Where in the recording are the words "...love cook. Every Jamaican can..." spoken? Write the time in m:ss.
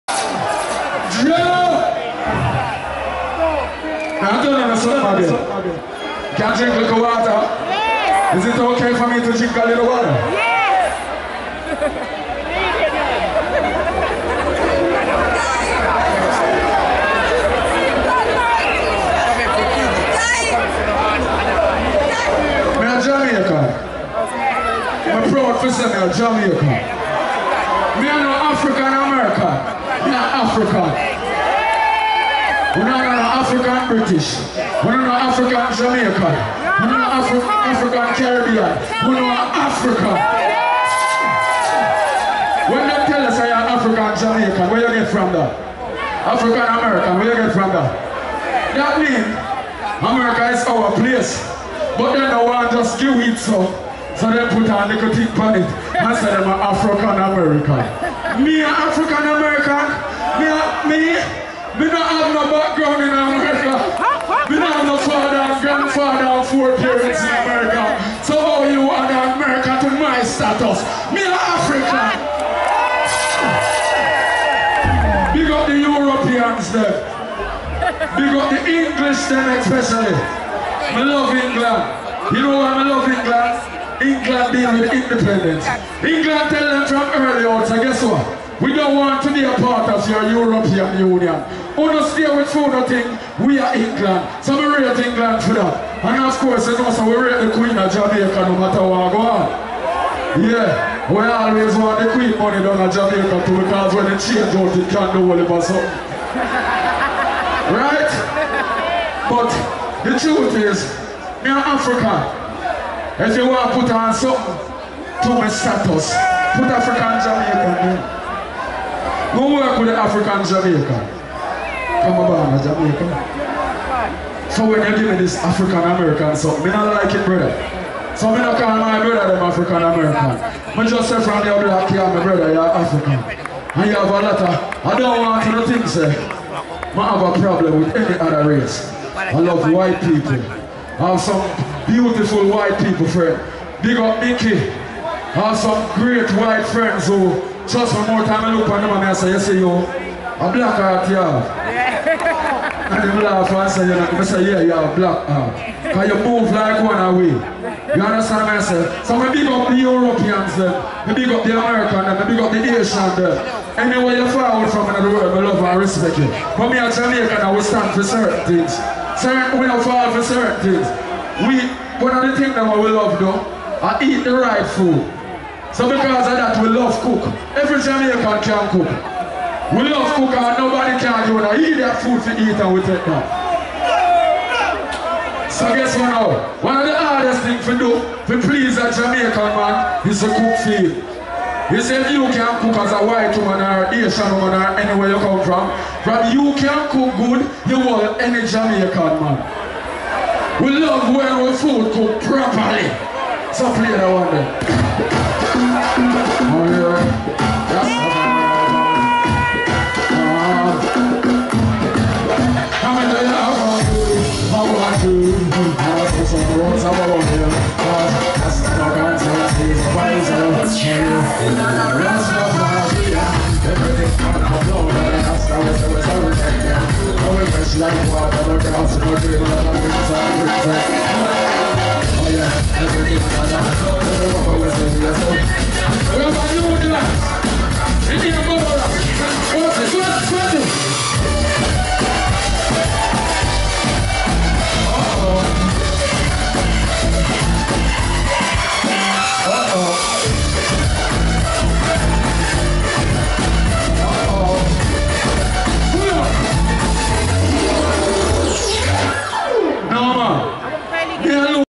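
2:56.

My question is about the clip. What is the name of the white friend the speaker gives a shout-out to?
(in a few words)
Mickey.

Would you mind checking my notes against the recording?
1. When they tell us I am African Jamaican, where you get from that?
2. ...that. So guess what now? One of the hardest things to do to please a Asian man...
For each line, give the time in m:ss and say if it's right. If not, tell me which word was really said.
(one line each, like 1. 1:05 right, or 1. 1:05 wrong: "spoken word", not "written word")
1. 0:42 right
2. 3:03 wrong: "Jamaican", not "Asian".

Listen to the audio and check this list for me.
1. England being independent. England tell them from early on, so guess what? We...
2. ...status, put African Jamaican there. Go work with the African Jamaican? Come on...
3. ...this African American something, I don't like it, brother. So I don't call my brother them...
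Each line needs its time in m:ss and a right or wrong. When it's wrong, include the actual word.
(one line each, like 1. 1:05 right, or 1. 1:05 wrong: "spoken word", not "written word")
1. 1:24 right
2. 1:55 right
3. 2:05 right.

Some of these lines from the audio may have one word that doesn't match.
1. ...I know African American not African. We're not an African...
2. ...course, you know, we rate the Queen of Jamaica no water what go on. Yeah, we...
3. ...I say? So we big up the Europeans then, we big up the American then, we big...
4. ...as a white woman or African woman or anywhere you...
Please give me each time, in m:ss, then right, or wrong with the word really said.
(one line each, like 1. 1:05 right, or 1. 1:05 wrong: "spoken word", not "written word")
1. 0:28 right
2. 1:36 wrong: "matter", not "water"
3. 2:38 right
4. 3:12 wrong: "Asian", not "African".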